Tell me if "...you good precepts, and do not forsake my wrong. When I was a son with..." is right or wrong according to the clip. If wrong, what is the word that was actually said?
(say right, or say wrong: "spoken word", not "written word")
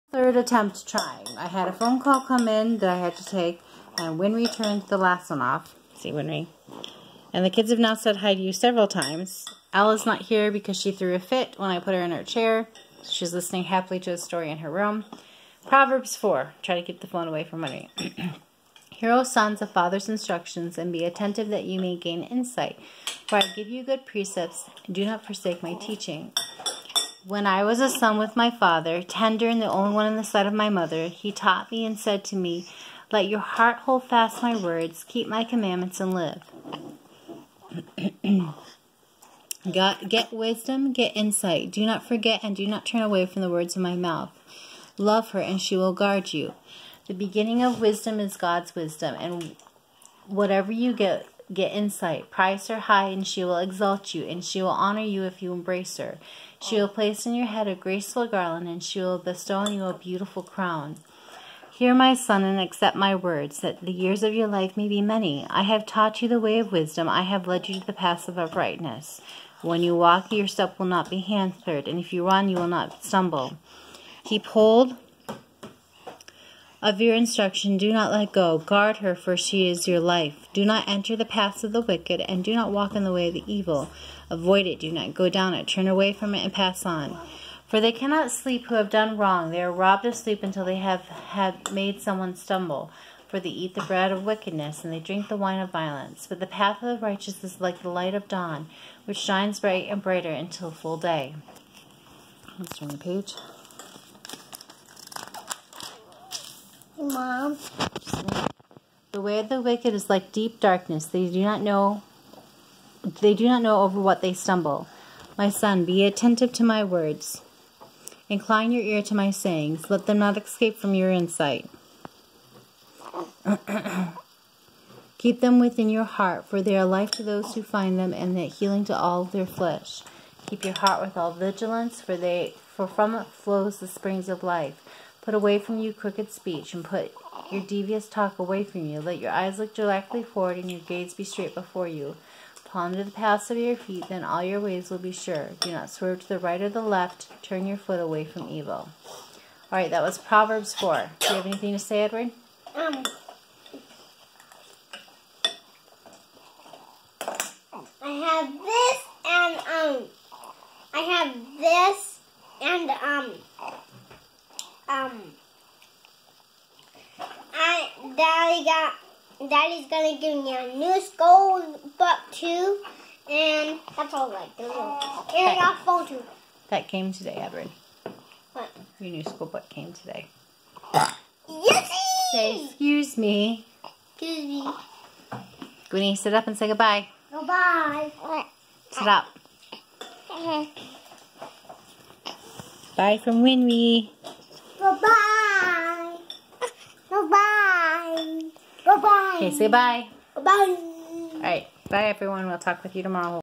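wrong: "teaching", not "wrong".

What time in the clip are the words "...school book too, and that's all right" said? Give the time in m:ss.
2:51.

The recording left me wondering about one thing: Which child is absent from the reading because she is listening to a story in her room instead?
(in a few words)
Ella.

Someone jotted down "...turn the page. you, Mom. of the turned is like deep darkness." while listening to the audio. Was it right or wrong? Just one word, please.
wrong.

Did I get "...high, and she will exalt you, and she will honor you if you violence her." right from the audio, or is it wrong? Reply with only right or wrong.
wrong.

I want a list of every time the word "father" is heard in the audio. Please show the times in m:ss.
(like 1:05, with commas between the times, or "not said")
0:19, 0:28.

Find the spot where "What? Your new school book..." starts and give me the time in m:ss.
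2:58.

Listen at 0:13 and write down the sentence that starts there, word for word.
She's listening happily to a story in her room.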